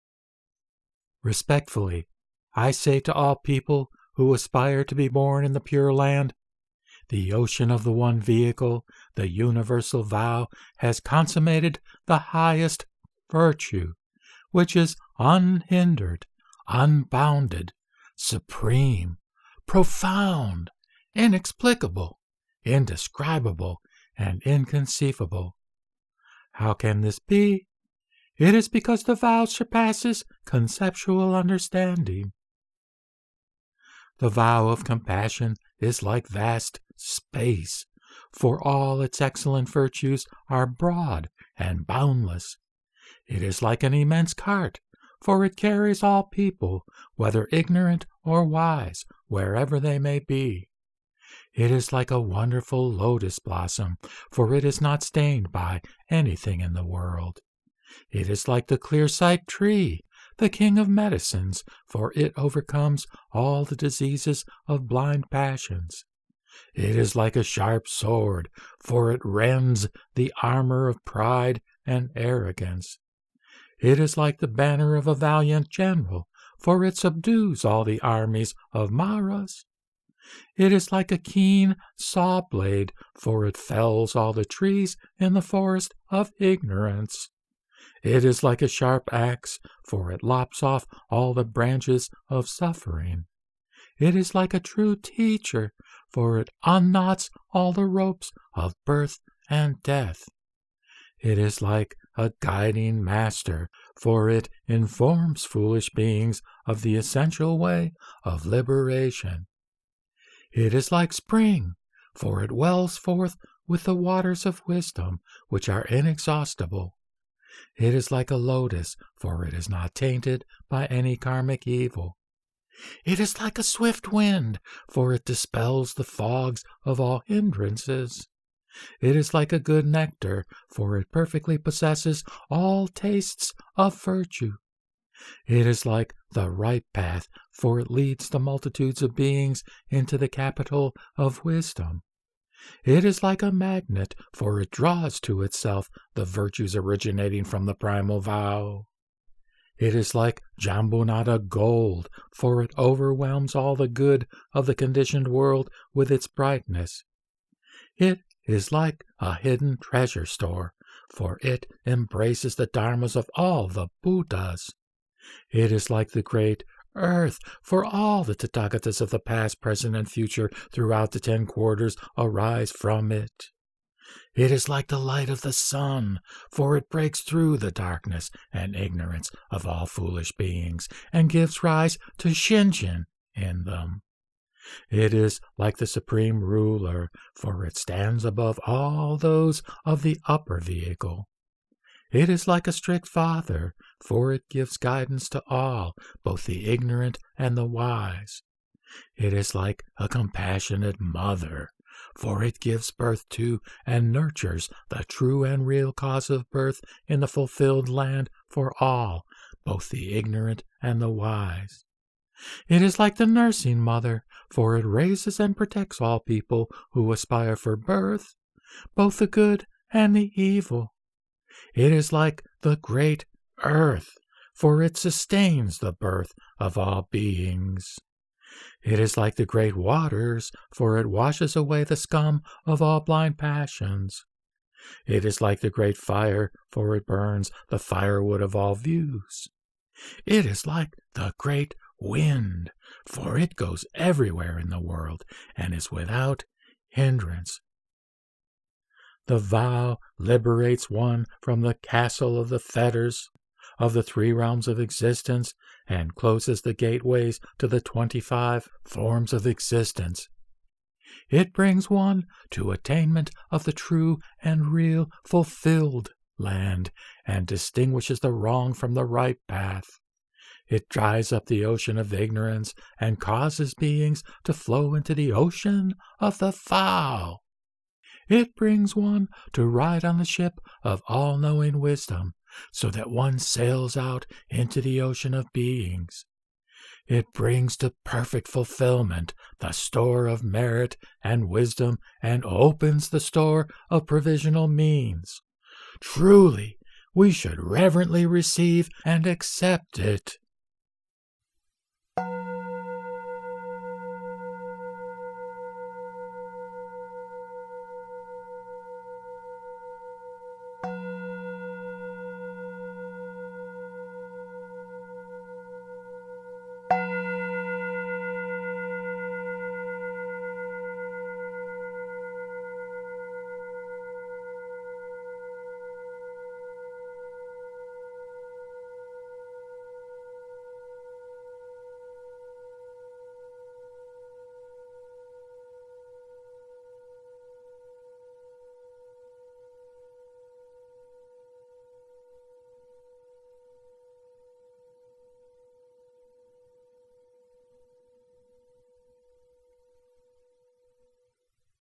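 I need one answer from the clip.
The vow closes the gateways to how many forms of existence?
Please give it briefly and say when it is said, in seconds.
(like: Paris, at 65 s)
25, at 257 s.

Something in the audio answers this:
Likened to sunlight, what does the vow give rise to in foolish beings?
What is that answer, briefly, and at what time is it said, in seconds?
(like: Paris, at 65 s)
Shinjin, at 182 s.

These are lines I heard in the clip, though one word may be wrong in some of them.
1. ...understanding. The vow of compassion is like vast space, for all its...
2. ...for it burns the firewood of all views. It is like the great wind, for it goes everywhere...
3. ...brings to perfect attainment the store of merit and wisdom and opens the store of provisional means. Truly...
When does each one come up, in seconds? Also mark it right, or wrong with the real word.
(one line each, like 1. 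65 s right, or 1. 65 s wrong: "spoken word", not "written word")
1. 31 s right
2. 236 s right
3. 287 s wrong: "fulfillment", not "attainment".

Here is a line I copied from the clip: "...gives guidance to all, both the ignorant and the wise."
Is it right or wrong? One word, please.
right.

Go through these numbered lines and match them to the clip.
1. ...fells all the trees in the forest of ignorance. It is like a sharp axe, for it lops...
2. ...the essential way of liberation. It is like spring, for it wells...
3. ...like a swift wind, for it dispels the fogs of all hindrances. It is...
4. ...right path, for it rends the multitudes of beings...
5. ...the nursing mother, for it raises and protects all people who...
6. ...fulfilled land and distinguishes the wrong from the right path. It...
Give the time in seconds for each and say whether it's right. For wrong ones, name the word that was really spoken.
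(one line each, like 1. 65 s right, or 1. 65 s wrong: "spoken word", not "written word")
1. 83 s right
2. 106 s right
3. 123 s right
4. 136 s wrong: "leads", not "rends"
5. 213 s right
6. 265 s right.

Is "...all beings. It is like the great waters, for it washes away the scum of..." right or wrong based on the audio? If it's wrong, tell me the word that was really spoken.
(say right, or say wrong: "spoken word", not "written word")
right.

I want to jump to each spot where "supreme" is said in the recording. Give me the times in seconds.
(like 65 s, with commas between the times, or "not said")
18 s, 185 s.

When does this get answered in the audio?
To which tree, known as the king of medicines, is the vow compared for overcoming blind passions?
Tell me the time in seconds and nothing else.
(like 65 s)
58 s.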